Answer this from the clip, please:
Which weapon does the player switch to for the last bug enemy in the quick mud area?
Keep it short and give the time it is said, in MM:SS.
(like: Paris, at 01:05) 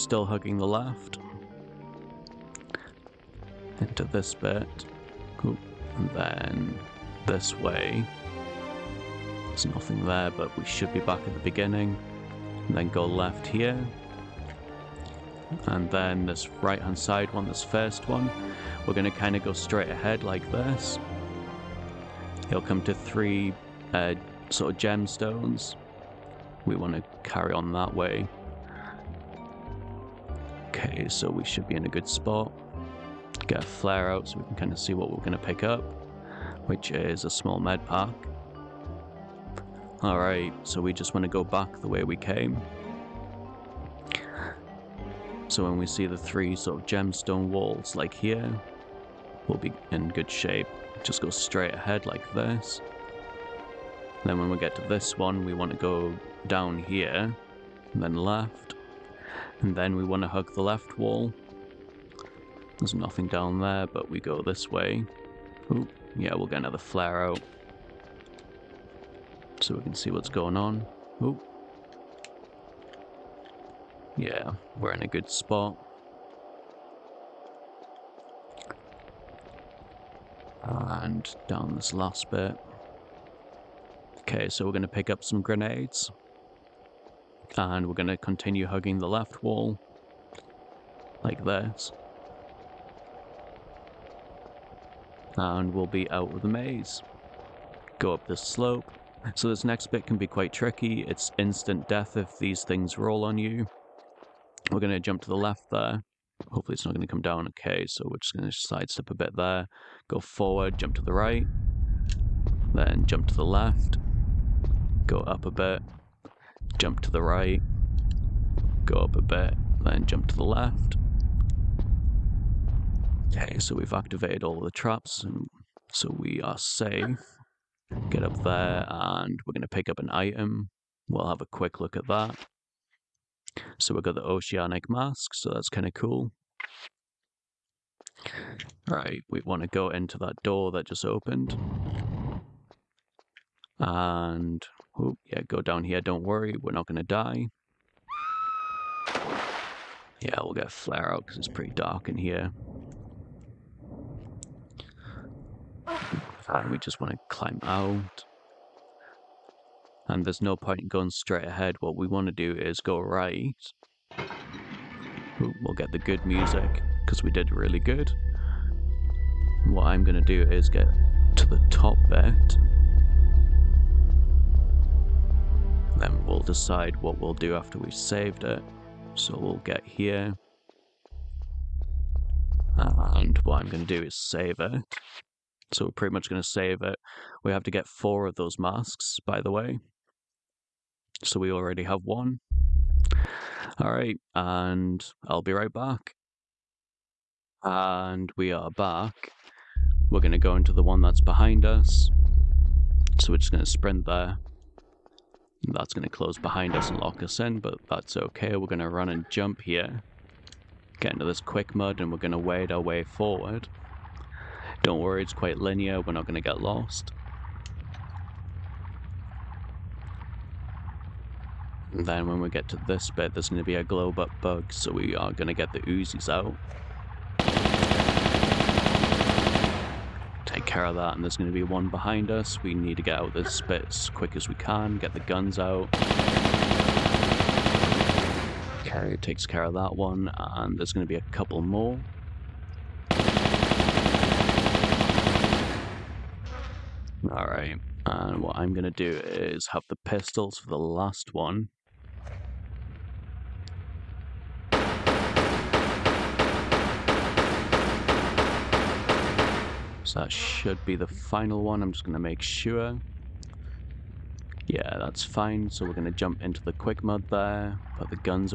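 pistols, at 04:10.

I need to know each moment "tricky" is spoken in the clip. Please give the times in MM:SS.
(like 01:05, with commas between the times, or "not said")
01:40.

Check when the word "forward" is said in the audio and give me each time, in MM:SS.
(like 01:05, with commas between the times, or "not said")
01:50, 03:33.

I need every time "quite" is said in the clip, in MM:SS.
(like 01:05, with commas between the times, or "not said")
01:40, 03:35.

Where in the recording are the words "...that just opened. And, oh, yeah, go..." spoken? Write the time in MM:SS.
02:20.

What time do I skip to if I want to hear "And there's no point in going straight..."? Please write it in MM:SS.
02:40.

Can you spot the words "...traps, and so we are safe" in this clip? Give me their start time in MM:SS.
02:04.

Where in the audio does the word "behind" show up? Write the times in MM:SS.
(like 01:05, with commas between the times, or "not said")
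03:21, 03:26, 03:51.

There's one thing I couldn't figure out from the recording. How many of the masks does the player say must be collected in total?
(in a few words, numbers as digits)
4.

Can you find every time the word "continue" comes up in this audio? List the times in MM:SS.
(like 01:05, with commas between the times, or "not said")
01:28.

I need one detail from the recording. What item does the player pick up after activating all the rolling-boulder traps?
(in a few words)
oceanic mask.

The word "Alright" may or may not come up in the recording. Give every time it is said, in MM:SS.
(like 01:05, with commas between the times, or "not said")
00:40, 03:13, 04:07.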